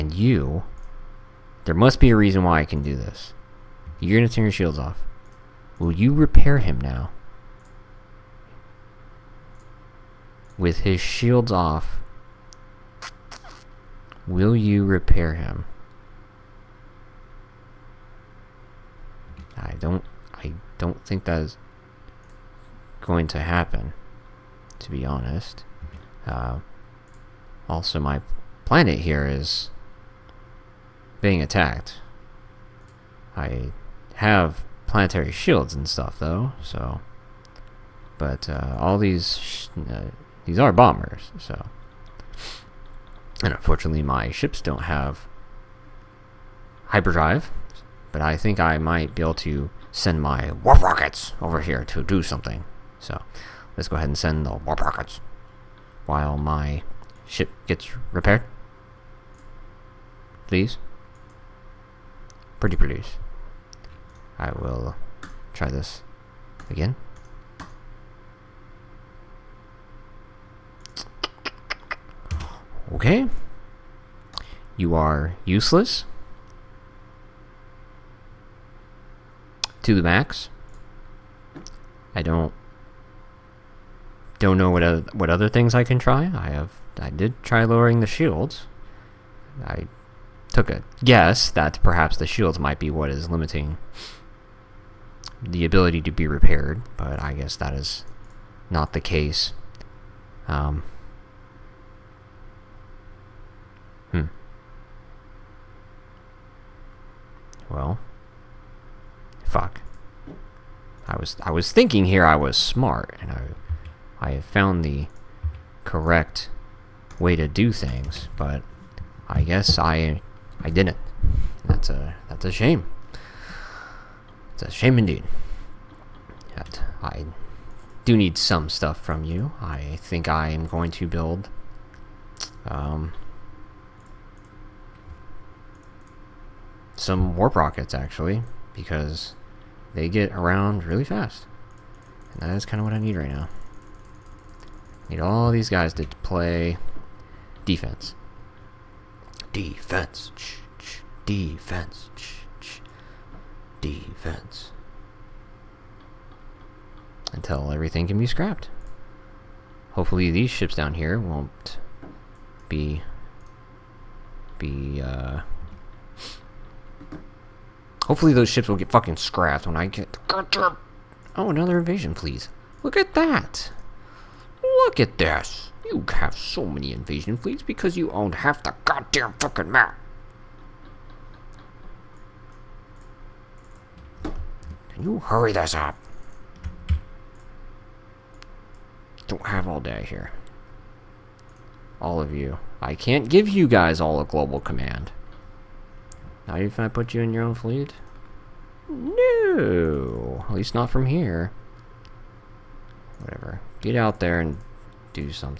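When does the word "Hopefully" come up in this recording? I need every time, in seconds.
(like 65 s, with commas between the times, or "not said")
159 s, 168 s.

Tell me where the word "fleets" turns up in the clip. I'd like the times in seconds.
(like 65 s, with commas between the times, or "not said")
177 s, 197 s.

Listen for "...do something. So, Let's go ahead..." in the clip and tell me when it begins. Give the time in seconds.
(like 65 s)
52 s.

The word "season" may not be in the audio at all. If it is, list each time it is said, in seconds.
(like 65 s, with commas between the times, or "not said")
not said.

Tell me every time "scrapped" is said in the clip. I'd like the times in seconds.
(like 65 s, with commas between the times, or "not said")
158 s, 169 s.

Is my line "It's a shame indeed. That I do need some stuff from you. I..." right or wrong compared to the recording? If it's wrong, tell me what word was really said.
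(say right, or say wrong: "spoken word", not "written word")
right.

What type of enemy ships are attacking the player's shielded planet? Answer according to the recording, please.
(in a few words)
Bombers.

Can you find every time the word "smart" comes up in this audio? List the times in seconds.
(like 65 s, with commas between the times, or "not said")
112 s.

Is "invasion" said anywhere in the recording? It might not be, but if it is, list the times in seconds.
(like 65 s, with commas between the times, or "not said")
171 s, 176 s.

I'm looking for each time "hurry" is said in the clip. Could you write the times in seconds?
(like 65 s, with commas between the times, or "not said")
185 s.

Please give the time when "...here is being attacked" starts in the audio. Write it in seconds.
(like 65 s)
28 s.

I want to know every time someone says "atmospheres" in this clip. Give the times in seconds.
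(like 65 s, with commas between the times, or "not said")
not said.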